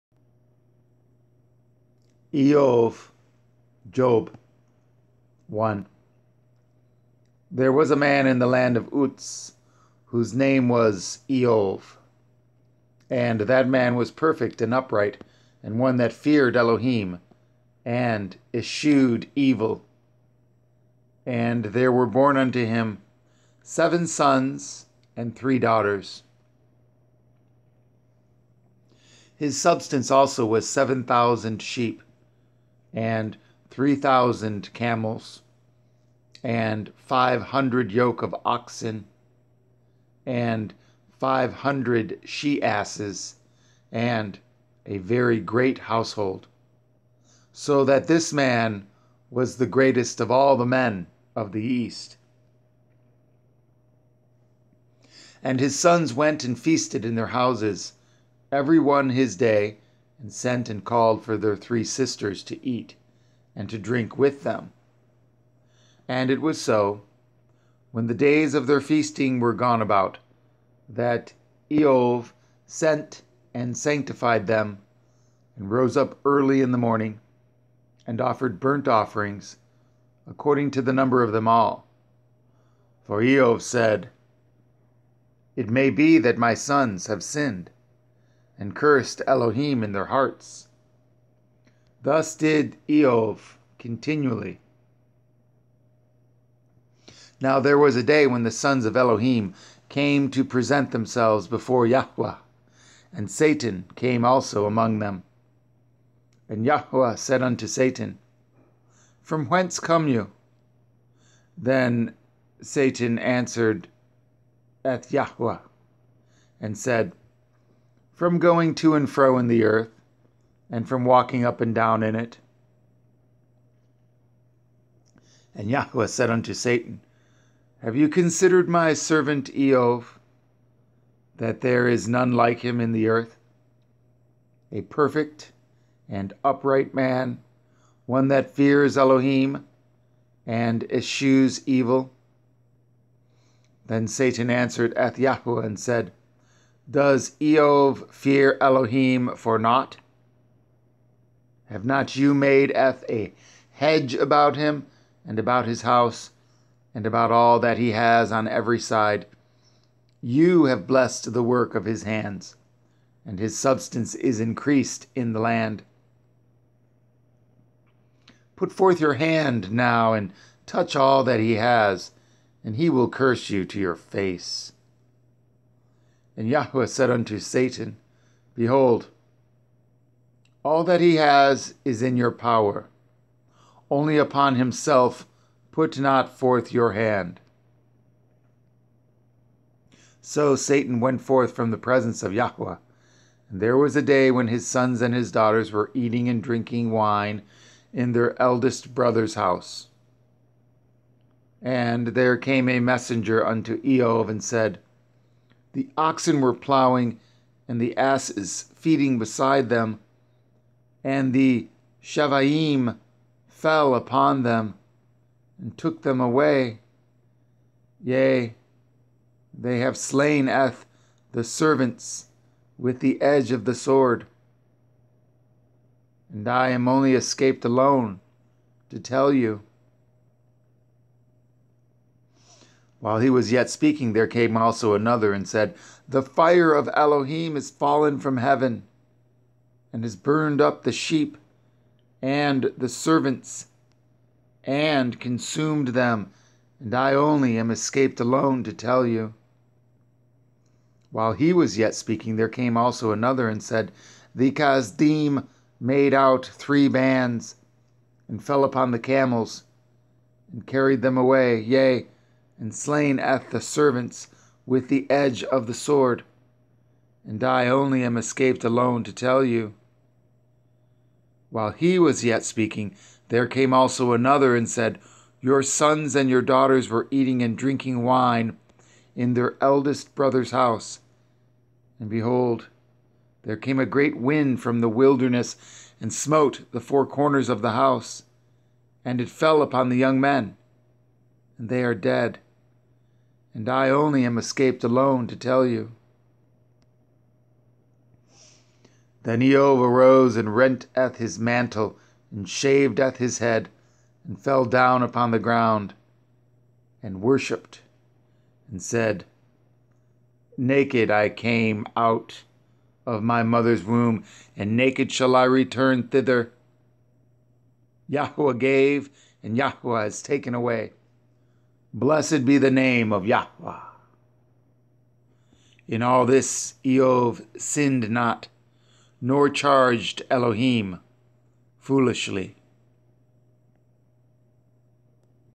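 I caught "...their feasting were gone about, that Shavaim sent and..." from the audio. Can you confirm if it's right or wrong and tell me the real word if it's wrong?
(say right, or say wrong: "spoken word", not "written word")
wrong: "Eov", not "Shavaim".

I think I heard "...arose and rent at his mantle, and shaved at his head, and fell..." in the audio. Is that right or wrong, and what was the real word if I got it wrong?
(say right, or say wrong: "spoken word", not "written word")
right.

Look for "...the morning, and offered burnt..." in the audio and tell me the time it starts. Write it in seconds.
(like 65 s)
76 s.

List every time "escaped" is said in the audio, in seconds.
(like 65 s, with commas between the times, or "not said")
227 s, 247 s, 268 s, 294 s.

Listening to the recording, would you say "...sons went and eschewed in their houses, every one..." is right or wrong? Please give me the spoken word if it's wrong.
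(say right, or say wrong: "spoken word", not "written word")
wrong: "feasted", not "eschewed".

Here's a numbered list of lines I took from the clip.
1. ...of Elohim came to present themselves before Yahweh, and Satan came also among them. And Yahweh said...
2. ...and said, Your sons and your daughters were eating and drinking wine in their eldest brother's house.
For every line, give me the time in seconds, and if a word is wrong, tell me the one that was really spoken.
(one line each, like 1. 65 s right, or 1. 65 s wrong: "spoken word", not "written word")
1. 98 s right
2. 274 s right.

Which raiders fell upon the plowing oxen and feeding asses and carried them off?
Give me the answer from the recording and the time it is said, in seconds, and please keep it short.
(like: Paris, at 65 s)
Shavaim, at 212 s.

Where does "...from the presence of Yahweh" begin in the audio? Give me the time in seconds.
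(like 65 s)
191 s.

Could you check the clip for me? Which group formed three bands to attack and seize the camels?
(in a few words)
Kasdim.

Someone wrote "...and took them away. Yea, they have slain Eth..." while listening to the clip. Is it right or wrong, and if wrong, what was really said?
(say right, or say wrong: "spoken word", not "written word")
right.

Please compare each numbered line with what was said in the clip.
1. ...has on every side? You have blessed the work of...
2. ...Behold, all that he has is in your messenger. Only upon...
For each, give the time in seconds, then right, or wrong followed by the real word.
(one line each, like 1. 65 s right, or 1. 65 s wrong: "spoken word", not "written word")
1. 157 s right
2. 178 s wrong: "power", not "messenger".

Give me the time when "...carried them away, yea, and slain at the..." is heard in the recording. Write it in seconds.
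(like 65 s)
260 s.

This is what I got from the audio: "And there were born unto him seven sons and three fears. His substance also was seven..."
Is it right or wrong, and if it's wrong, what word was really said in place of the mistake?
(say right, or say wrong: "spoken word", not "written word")
wrong: "daughters", not "fears".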